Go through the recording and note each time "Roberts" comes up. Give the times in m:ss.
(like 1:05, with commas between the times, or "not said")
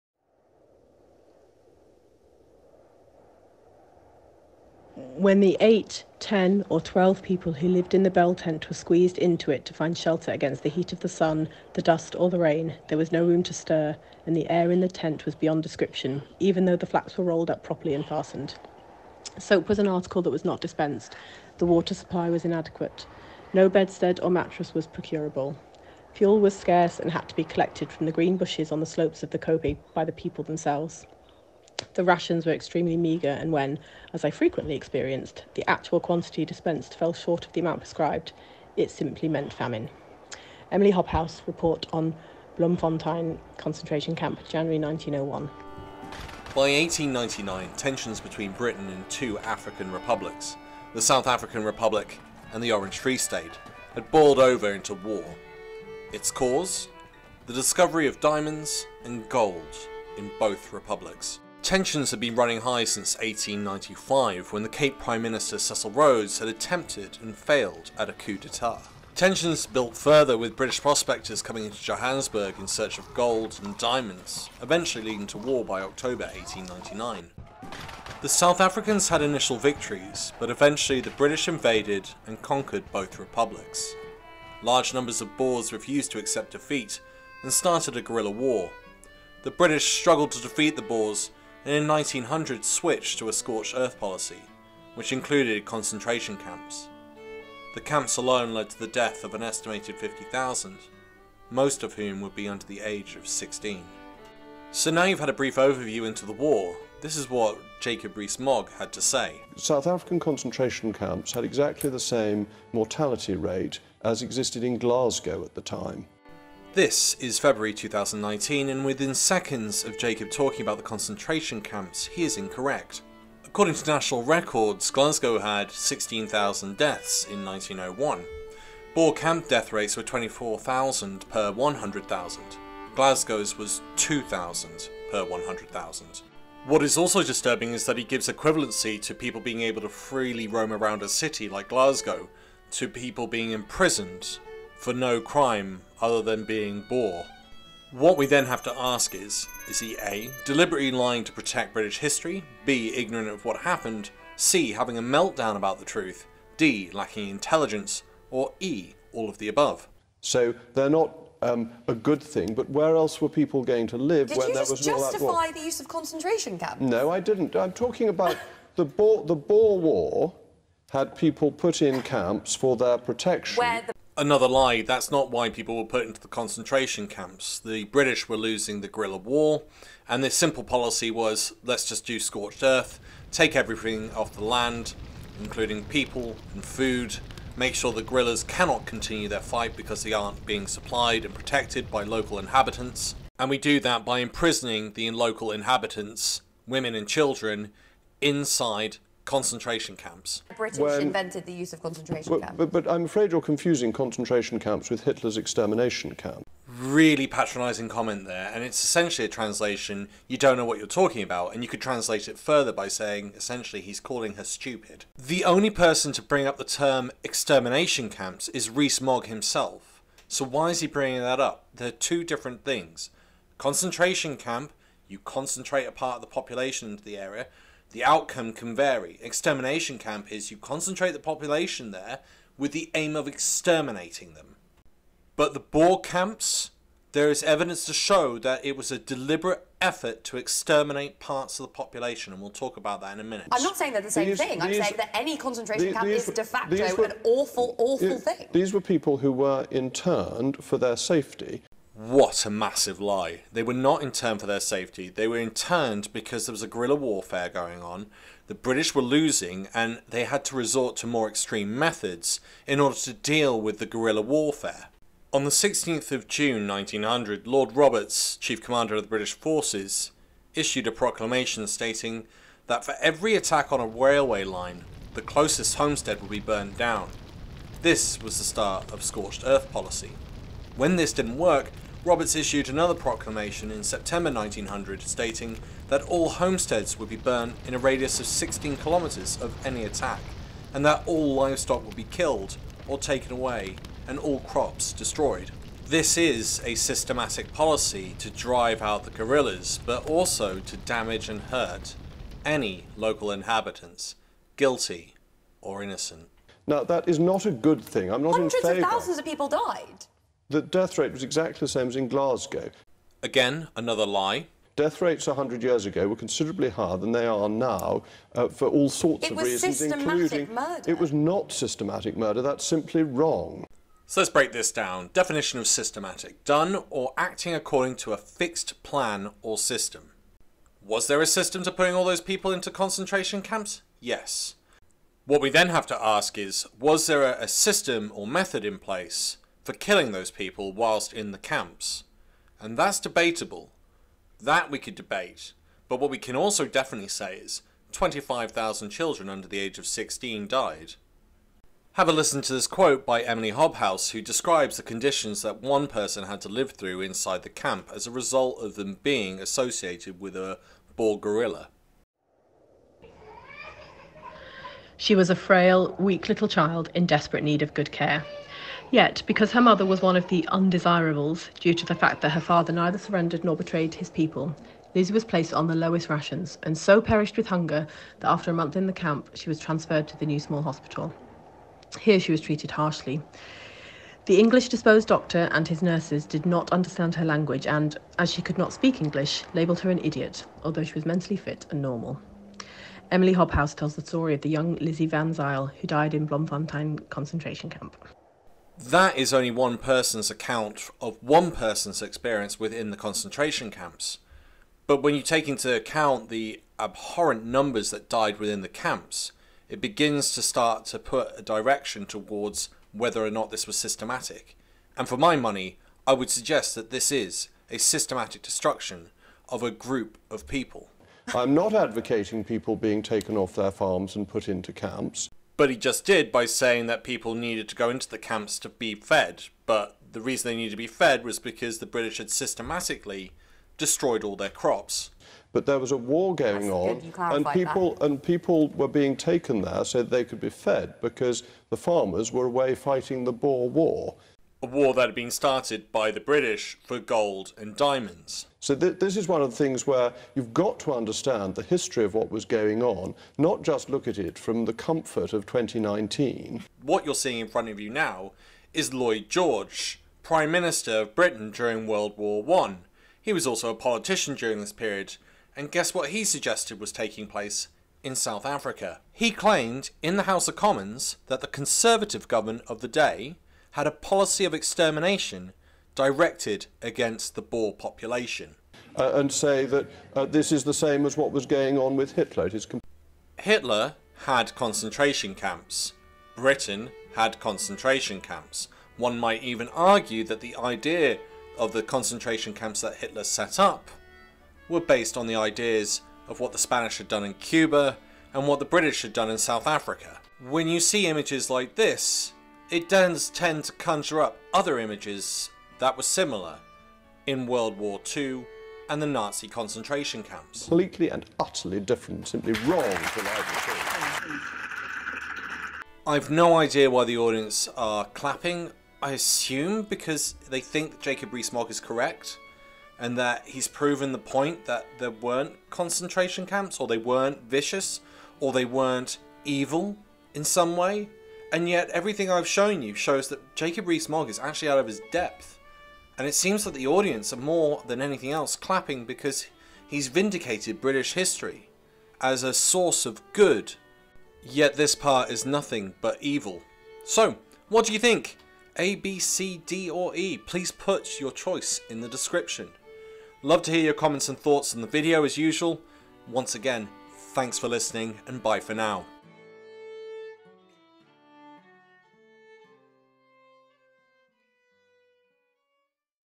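4:27, 4:42.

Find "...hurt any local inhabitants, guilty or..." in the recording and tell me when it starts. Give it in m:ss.
5:01.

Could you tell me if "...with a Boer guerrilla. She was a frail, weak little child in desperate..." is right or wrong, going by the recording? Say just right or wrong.
right.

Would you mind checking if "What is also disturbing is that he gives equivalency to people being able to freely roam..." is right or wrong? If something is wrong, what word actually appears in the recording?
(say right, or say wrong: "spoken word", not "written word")
right.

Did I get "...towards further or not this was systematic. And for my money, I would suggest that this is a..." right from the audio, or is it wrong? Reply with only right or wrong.
wrong.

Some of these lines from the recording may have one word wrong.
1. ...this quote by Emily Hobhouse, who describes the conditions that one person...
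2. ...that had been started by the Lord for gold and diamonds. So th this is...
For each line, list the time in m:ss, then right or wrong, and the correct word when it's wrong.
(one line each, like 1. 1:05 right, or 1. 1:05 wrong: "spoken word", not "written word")
1. 5:52 right
2. 7:24 wrong: "British", not "Lord".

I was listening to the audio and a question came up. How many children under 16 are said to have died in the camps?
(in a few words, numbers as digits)
25,000.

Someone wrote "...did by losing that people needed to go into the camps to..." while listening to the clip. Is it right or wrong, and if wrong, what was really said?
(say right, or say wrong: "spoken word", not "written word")
wrong: "saying", not "losing".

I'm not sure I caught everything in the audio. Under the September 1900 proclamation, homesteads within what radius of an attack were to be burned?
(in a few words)
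16 kilometres.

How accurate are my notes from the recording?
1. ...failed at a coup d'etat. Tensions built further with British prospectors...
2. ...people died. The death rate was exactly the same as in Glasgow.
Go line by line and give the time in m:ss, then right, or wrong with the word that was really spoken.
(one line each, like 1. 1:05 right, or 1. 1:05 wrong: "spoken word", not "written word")
1. 1:07 right
2. 5:09 right.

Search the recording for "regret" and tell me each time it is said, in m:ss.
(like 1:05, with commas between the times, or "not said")
not said.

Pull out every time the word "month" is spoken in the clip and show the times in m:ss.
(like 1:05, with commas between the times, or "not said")
6:18.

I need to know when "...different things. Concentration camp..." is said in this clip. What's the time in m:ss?
3:42.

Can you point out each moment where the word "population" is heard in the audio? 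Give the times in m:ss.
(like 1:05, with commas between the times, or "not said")
3:46, 3:51, 4:01, 7:57.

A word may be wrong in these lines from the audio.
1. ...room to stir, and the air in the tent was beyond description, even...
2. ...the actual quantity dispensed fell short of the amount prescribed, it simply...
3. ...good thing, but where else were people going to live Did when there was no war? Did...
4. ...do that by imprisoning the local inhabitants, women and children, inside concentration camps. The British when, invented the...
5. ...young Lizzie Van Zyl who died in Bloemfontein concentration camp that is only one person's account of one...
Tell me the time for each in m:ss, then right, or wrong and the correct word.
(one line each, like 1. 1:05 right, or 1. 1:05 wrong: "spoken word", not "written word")
1. 0:13 right
2. 0:35 right
3. 2:41 right
4. 3:13 right
5. 6:34 right.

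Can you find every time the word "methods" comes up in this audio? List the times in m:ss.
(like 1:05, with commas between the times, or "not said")
4:21, 5:38.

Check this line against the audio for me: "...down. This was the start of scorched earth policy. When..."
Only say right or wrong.
right.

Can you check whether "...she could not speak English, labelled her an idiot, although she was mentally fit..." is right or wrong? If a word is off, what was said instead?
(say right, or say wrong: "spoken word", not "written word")
right.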